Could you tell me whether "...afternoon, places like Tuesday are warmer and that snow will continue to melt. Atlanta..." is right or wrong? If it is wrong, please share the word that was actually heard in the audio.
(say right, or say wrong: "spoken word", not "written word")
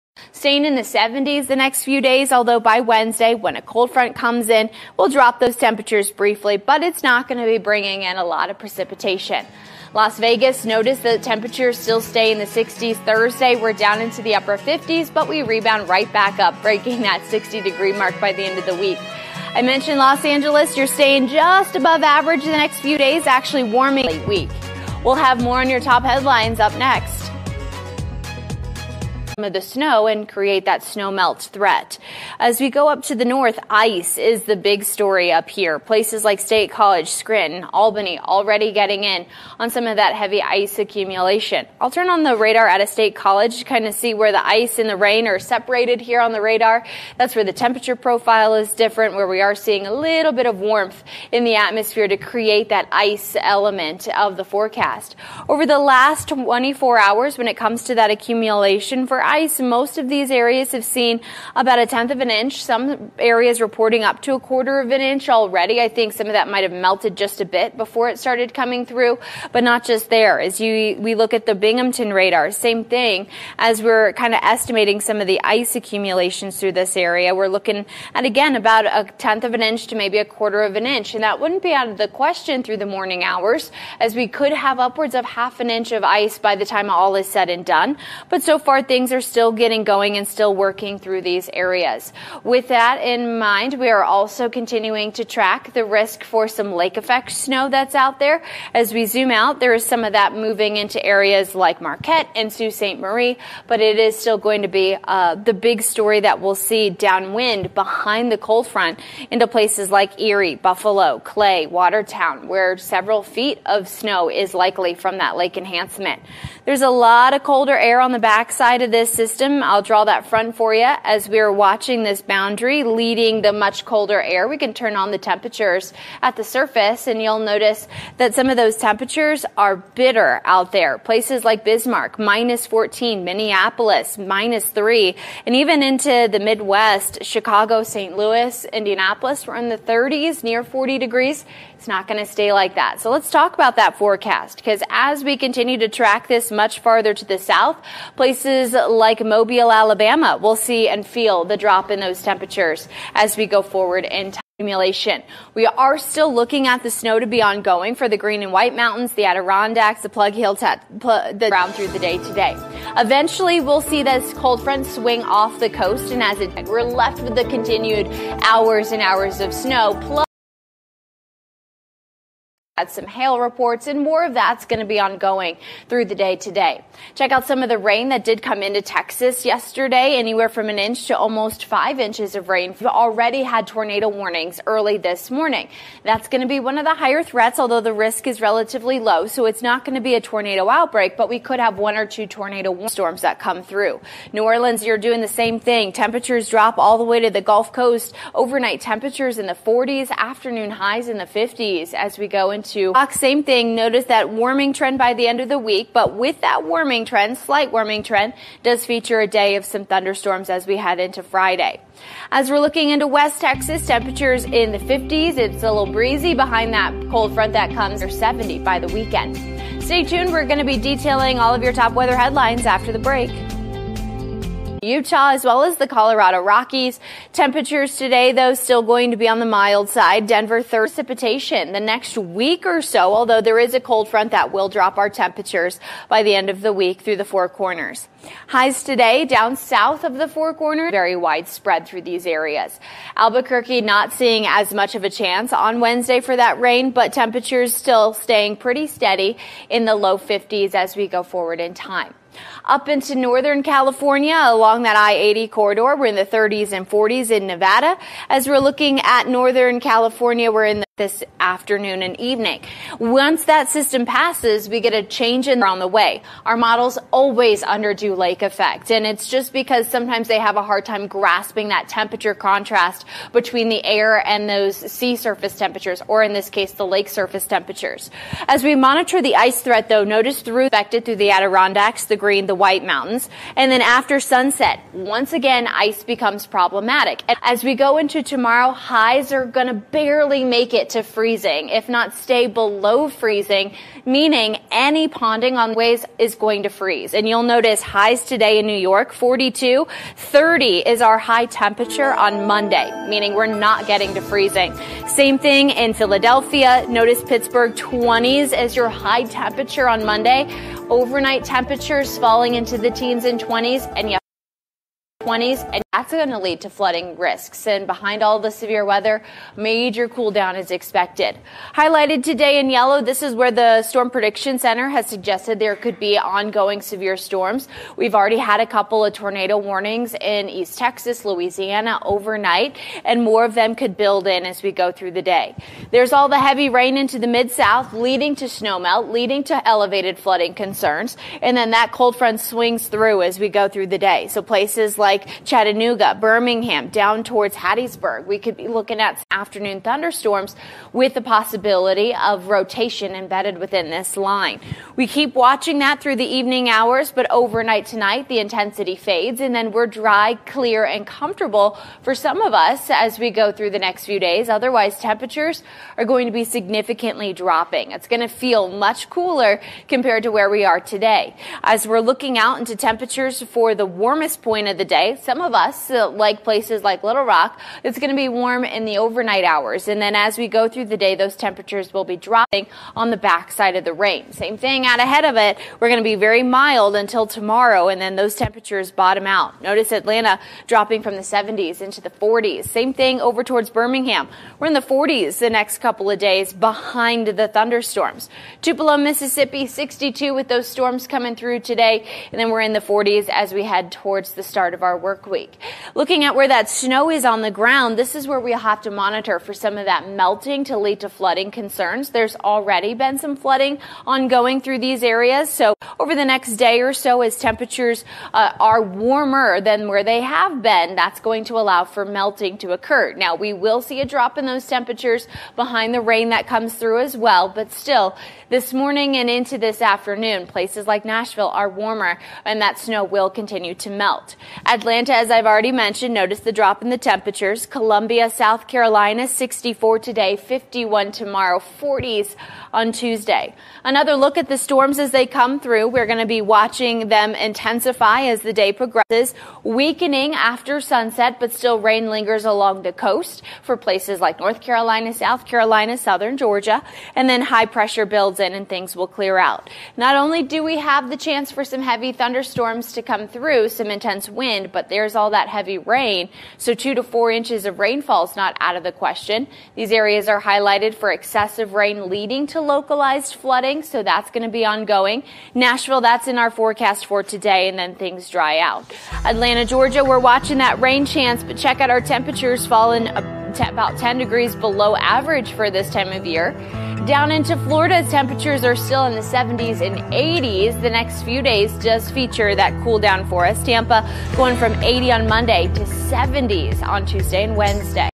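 wrong: "Nashville", not "Tuesday".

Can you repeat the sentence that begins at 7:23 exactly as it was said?
Another look at the storms as they come through.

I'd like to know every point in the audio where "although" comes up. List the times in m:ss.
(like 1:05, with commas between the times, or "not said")
0:02, 3:07, 3:53.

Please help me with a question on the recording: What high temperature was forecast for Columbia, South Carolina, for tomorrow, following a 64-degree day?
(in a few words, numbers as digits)
51.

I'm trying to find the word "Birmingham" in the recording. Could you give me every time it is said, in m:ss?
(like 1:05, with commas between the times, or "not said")
5:46, 6:33.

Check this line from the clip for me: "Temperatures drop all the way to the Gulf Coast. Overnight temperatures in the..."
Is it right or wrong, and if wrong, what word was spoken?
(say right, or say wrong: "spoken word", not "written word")
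right.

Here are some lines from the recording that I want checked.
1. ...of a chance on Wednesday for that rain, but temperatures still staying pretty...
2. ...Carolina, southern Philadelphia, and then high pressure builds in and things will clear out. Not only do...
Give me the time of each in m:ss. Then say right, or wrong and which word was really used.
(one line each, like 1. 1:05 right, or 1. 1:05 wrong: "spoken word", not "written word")
1. 4:04 right
2. 7:35 wrong: "Georgia", not "Philadelphia".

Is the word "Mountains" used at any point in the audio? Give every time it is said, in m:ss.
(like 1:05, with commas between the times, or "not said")
2:38, 4:42.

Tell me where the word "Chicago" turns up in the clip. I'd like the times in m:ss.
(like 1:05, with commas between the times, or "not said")
2:17.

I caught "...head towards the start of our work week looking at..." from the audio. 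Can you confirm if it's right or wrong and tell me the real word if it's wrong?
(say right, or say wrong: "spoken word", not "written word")
right.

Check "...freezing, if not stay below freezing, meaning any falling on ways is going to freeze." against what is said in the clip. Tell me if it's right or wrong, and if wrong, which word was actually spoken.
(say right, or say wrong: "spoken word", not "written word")
wrong: "ponding", not "falling".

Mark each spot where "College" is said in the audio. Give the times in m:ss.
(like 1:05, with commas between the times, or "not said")
0:36, 0:43.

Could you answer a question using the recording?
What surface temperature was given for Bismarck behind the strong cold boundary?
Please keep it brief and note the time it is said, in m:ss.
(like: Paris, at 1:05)
-14, at 2:12.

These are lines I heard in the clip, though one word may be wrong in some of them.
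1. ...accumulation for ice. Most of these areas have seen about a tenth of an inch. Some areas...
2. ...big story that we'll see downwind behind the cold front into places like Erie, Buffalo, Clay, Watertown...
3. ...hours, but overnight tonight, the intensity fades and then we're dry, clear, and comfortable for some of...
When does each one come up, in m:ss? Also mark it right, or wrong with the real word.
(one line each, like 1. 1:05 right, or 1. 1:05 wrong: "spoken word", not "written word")
1. 0:58 right
2. 1:45 right
3. 5:56 right.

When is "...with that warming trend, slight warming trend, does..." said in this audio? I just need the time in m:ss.
3:26.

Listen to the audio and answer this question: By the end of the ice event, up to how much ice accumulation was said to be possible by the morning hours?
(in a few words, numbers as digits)
half an inch.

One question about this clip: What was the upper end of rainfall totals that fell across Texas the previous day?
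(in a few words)
almost 5 inches.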